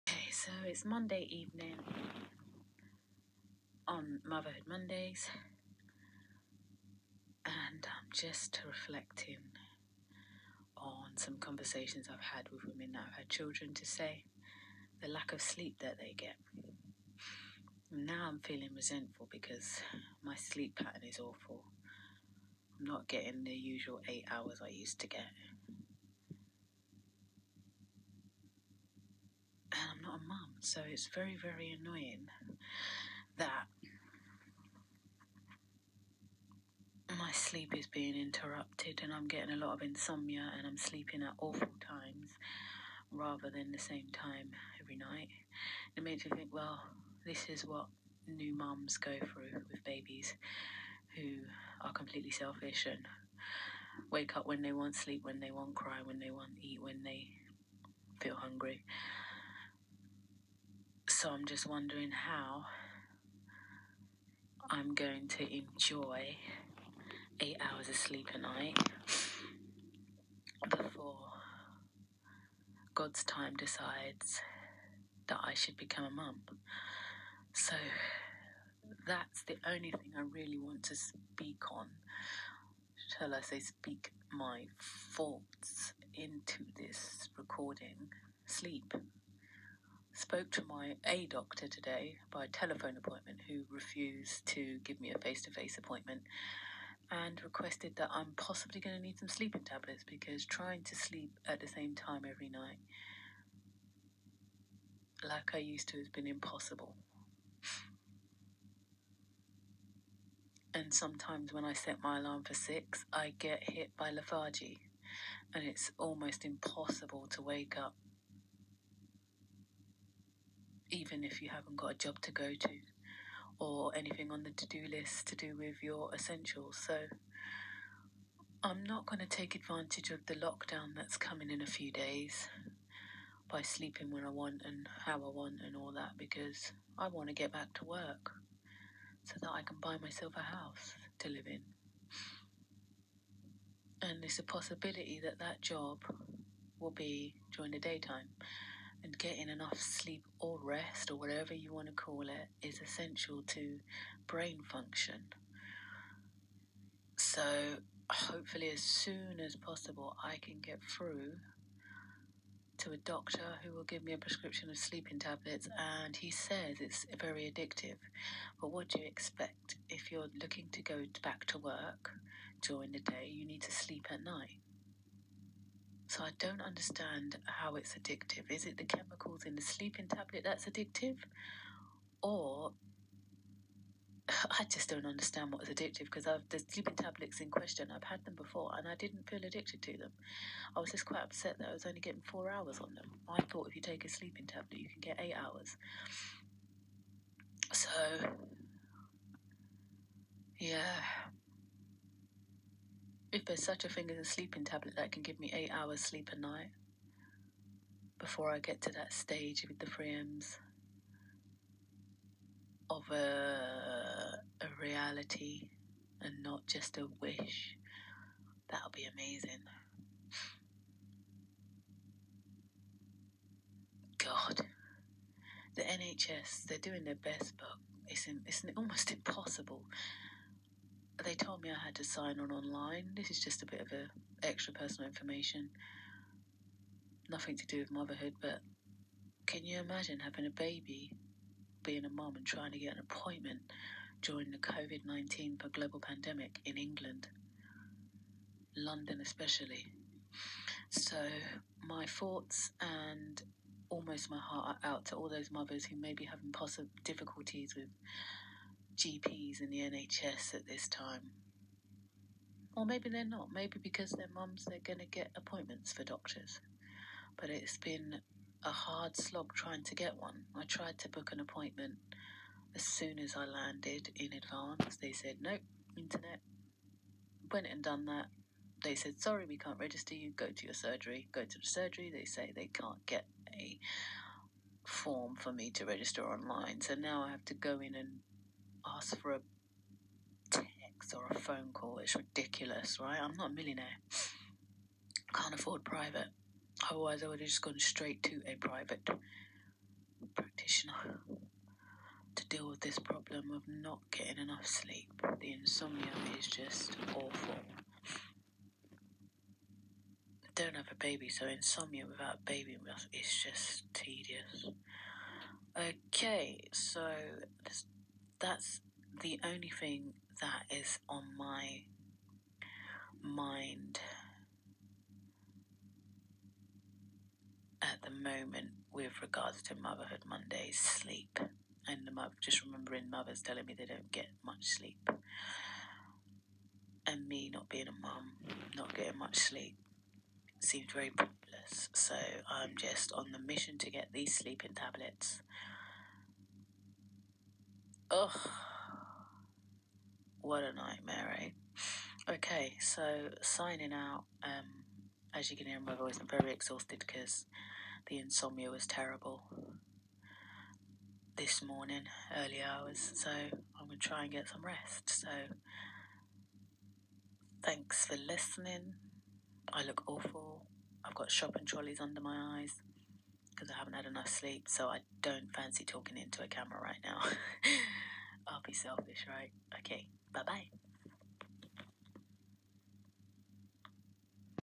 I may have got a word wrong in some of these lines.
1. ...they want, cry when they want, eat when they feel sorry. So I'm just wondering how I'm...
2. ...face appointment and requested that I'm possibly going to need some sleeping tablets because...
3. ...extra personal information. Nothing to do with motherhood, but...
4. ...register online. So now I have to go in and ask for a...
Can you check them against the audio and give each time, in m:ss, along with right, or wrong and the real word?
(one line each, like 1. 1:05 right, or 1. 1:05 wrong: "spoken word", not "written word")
1. 0:55 wrong: "hungry", not "sorry"
2. 1:35 right
3. 3:54 right
4. 4:45 right.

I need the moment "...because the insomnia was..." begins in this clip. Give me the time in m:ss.
5:56.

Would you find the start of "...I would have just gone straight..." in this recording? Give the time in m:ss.
4:57.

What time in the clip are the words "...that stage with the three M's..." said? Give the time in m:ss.
3:28.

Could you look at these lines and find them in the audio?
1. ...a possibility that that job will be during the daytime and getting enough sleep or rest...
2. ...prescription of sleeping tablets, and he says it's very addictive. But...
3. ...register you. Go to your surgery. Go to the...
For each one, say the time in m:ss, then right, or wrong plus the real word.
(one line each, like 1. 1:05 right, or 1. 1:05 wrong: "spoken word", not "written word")
1. 2:24 right
2. 2:44 right
3. 4:39 right.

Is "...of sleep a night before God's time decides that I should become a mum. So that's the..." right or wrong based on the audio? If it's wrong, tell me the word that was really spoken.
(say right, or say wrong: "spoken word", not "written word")
right.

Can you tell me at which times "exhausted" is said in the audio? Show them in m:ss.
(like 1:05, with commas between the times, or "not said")
5:56.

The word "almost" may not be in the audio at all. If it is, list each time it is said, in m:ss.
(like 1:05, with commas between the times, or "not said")
1:55, 3:48, 4:13.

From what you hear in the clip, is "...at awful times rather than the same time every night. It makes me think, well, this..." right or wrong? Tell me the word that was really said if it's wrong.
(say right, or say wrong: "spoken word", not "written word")
right.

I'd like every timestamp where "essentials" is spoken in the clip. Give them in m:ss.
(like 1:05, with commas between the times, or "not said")
2:06, 2:32.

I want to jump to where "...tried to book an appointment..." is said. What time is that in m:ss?
4:30.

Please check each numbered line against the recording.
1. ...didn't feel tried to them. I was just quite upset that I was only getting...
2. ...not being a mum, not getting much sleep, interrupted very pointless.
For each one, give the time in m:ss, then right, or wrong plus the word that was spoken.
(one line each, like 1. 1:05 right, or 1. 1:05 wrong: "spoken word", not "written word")
1. 3:08 wrong: "addicted", not "tried"
2. 5:37 wrong: "seemed", not "interrupted".